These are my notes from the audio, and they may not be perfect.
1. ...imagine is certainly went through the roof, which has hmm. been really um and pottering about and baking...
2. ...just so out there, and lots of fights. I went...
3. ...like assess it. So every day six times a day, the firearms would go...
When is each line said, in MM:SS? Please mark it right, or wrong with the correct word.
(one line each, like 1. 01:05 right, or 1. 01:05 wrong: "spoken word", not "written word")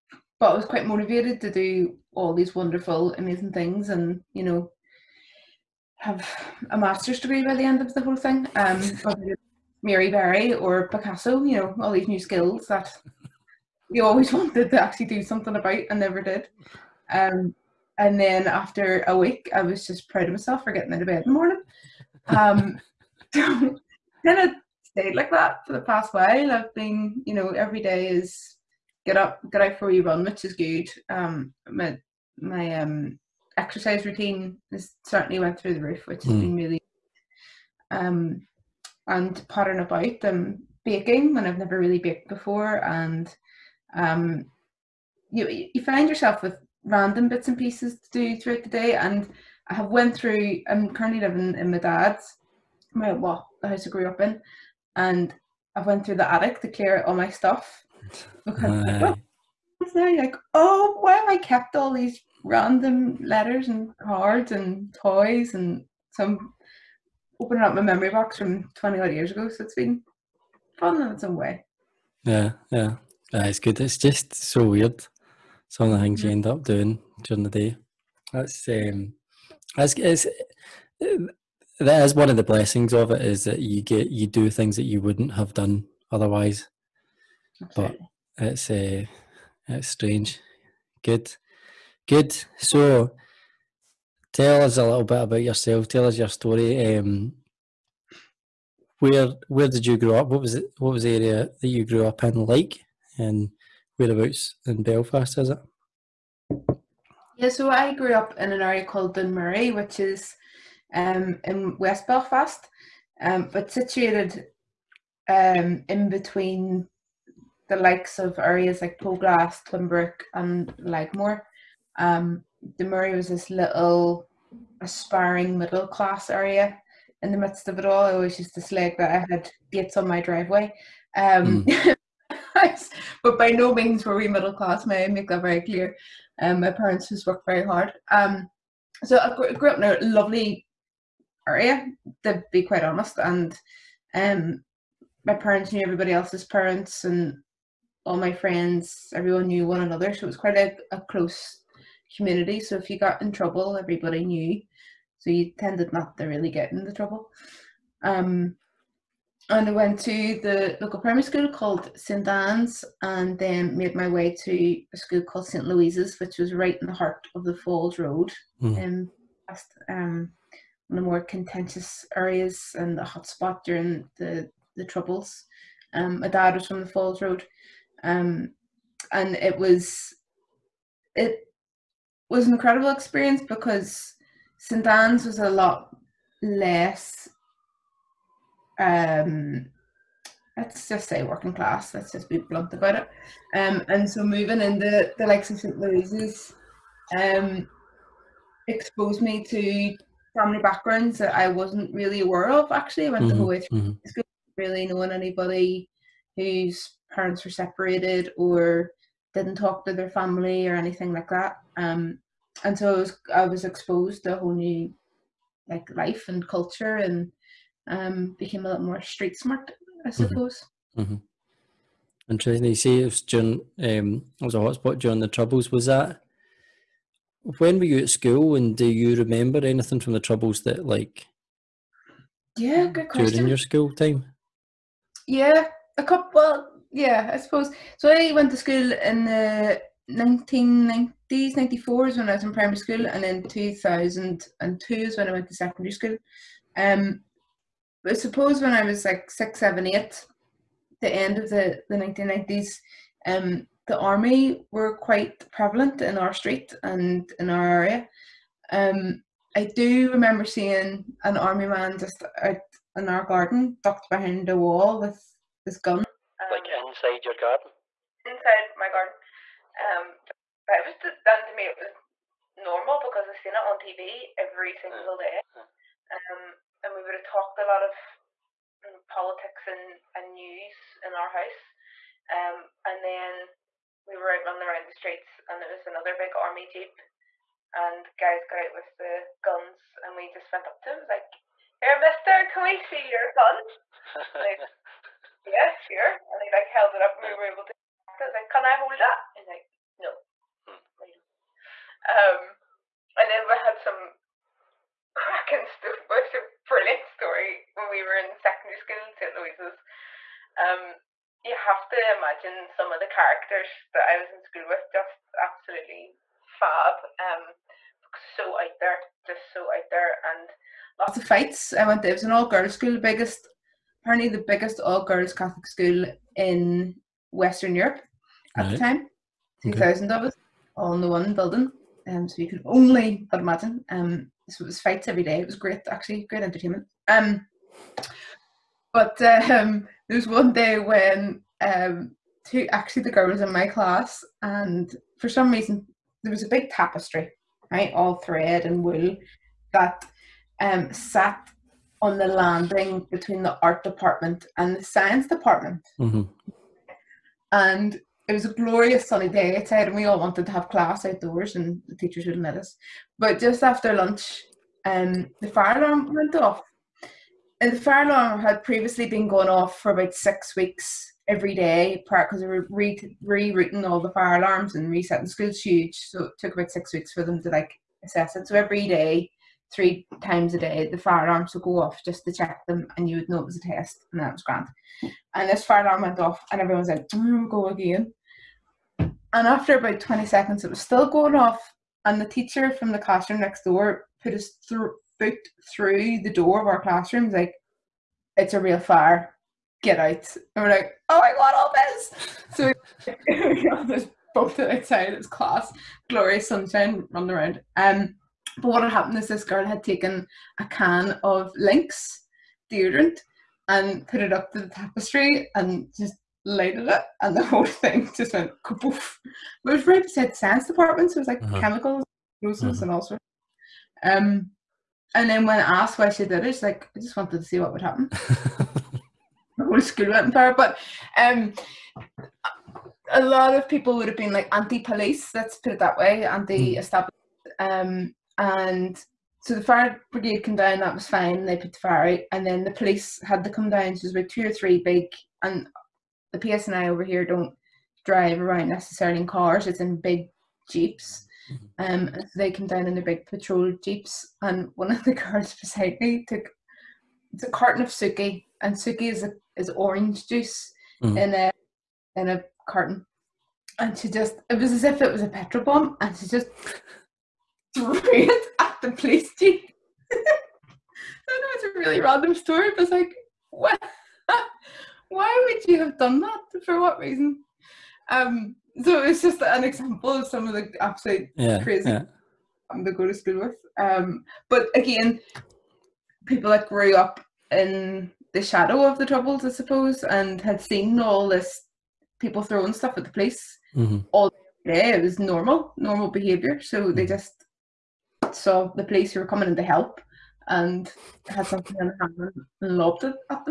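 1. 00:34 wrong: "routine", not "imagine"
2. 05:19 right
3. 06:17 wrong: "three", not "six".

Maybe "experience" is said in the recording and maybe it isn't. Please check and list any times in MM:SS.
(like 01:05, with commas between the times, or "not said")
03:02.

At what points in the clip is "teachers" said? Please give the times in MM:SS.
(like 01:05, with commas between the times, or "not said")
06:01, 06:32.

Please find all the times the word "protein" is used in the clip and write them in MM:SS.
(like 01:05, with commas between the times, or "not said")
not said.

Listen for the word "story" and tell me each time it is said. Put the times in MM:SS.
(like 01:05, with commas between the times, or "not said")
01:36, 05:07, 07:52.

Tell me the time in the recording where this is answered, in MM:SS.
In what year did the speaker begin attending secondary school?
04:03.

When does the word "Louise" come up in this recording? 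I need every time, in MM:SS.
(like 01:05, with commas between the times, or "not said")
02:45, 03:15, 05:09.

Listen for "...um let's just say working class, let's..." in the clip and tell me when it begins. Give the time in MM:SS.
03:08.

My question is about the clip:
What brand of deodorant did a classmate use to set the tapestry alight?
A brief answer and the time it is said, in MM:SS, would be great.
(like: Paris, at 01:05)
Lynx, at 06:51.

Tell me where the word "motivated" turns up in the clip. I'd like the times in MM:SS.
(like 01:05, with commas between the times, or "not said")
00:00.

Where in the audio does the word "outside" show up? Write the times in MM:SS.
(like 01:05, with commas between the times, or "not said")
05:59, 06:44.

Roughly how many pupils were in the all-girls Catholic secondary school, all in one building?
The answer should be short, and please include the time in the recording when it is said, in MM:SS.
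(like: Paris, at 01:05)
2000, at 05:29.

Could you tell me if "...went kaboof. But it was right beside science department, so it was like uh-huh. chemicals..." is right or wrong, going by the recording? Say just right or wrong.
right.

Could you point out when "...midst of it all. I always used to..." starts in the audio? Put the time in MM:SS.
02:07.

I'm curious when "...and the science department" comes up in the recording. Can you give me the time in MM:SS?
05:54.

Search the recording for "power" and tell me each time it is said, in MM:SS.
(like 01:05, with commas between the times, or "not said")
07:10.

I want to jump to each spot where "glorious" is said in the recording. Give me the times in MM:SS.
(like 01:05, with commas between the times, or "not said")
05:58, 06:46.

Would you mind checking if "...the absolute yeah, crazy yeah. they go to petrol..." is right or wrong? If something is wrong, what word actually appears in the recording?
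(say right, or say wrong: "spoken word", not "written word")
wrong: "school", not "petrol".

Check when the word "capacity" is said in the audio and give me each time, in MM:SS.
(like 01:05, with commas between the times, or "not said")
not said.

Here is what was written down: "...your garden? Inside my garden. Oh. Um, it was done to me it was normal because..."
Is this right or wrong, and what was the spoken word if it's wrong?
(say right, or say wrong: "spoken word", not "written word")
right.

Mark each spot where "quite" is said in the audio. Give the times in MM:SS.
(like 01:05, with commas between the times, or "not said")
00:00, 02:22, 02:30, 04:14.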